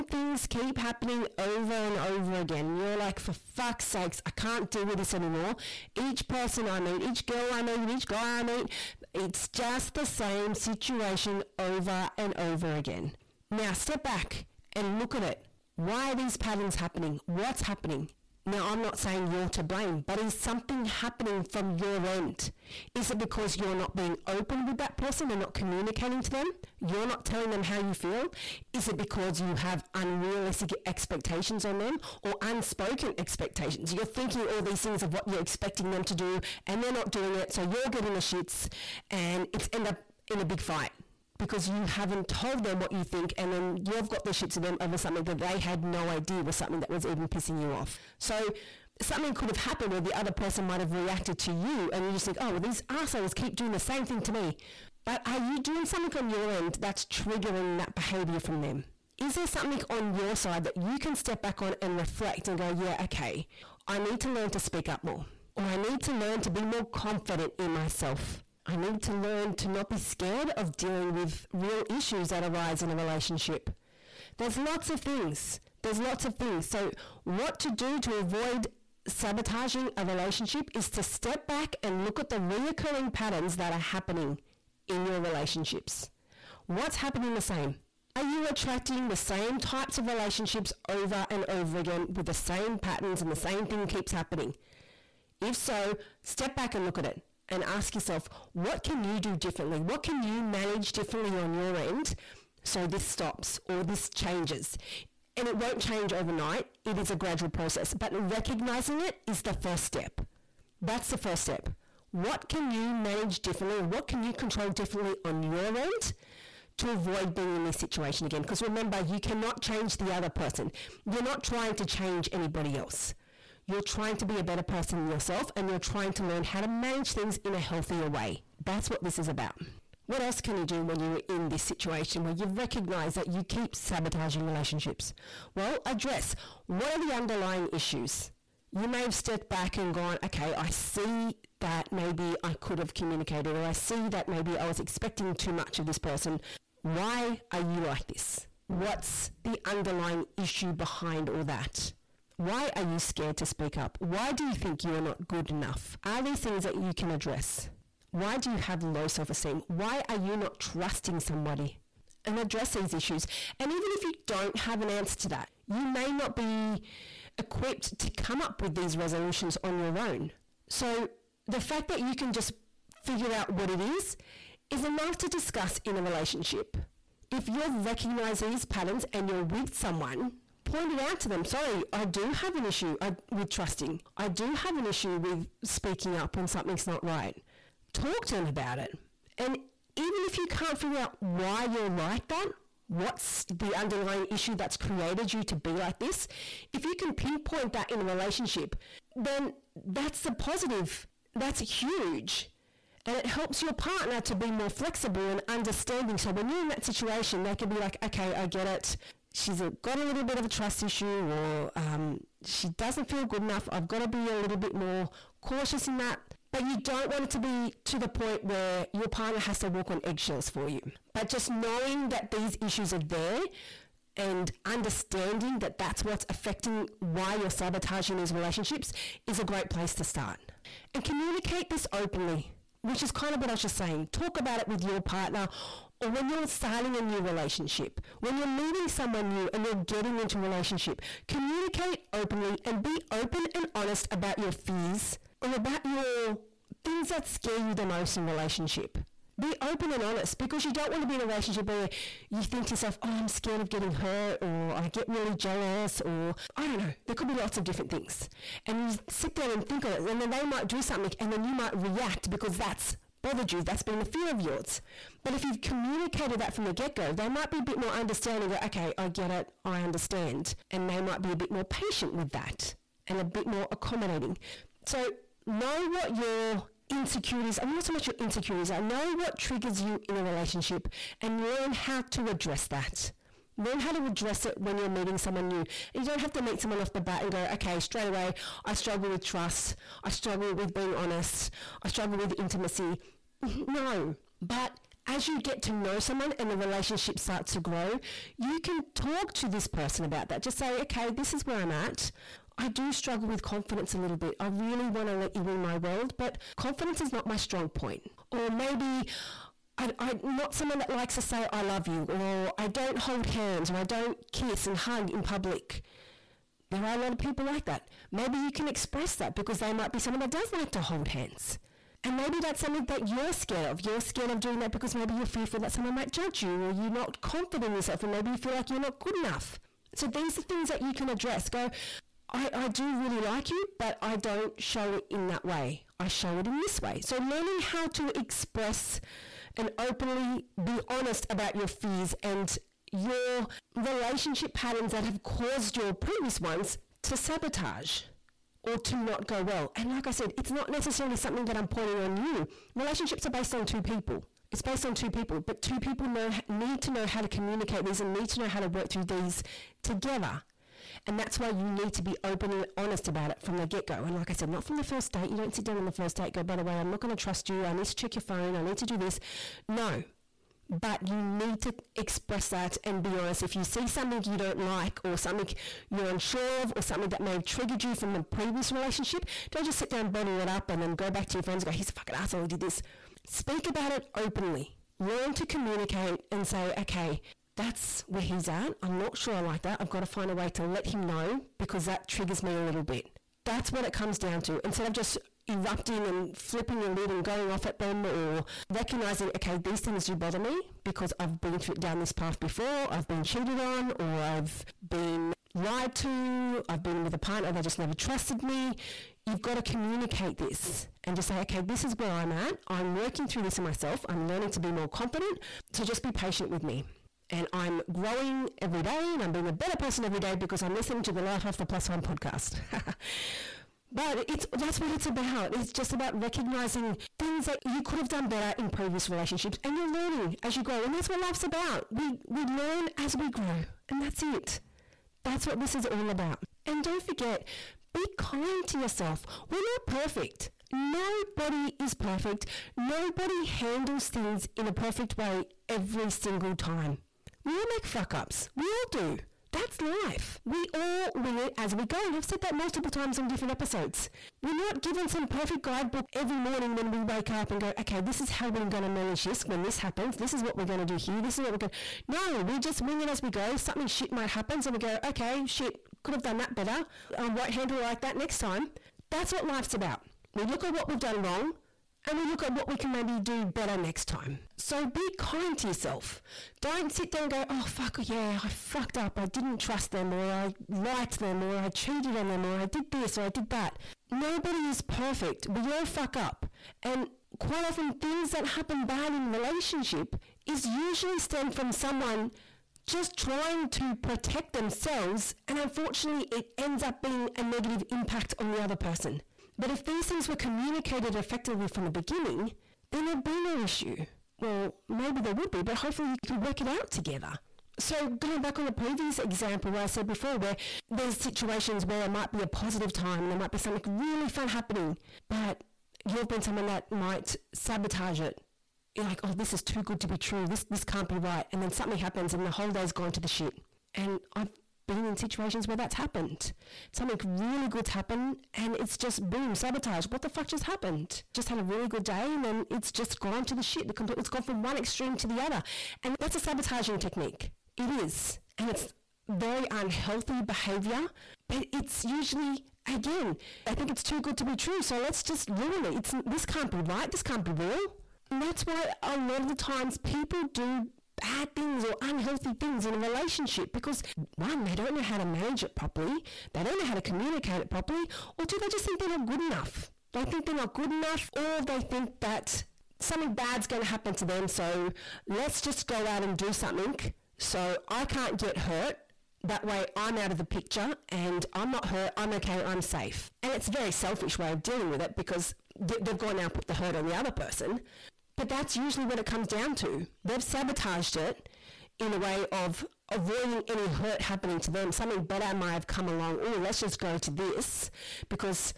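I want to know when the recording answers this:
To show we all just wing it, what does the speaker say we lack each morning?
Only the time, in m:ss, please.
7:35.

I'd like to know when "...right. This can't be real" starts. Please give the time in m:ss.
9:06.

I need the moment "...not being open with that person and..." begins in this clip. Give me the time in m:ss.
0:23.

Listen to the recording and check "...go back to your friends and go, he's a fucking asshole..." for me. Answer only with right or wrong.
right.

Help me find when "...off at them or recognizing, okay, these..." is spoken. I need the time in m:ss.
6:37.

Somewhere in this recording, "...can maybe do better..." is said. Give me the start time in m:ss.
7:52.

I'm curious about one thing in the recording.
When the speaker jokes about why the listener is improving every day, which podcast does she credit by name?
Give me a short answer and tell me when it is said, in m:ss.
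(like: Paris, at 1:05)
Life After Plus One, at 7:01.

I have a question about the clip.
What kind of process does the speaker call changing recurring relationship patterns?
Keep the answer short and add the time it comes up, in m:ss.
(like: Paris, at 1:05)
gradual process, at 1:47.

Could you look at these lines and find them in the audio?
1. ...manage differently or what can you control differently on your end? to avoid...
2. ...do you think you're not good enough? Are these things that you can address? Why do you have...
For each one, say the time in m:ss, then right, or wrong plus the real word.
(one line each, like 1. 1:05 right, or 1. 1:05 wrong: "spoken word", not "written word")
1. 1:52 right
2. 2:34 right.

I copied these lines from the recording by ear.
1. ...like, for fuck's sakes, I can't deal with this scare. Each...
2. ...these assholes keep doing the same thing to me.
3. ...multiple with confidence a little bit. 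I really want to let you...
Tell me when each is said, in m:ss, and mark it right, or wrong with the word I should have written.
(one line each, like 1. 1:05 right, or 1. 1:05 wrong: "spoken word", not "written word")
1. 0:02 wrong: "anymore", not "scare"
2. 0:52 right
3. 5:02 wrong: "struggle", not "multiple".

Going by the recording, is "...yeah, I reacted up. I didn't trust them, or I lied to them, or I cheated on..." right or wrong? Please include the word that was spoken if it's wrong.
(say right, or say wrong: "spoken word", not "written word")
wrong: "fucked", not "reacted".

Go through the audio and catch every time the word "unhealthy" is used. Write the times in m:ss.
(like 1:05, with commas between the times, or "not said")
8:59, 9:12.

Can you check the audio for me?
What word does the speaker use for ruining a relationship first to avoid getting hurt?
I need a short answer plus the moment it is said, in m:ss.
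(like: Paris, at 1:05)
selfish, at 9:33.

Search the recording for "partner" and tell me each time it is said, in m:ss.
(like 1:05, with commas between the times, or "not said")
3:23, 3:39, 3:55, 6:47.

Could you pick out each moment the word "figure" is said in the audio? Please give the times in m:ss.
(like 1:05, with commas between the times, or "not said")
2:53, 3:10.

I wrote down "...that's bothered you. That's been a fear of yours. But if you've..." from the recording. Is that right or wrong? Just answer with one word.
right.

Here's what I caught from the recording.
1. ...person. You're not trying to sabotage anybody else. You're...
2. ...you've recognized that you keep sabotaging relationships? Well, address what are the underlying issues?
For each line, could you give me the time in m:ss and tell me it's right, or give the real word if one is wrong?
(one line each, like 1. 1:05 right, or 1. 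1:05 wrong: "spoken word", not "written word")
1. 2:00 wrong: "change", not "sabotage"
2. 2:12 right.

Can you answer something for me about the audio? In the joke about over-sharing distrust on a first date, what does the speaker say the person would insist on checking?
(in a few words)
your phone.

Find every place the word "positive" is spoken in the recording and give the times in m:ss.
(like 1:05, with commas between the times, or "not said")
3:20, 8:32.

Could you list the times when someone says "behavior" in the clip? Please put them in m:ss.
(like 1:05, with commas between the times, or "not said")
0:57, 9:00.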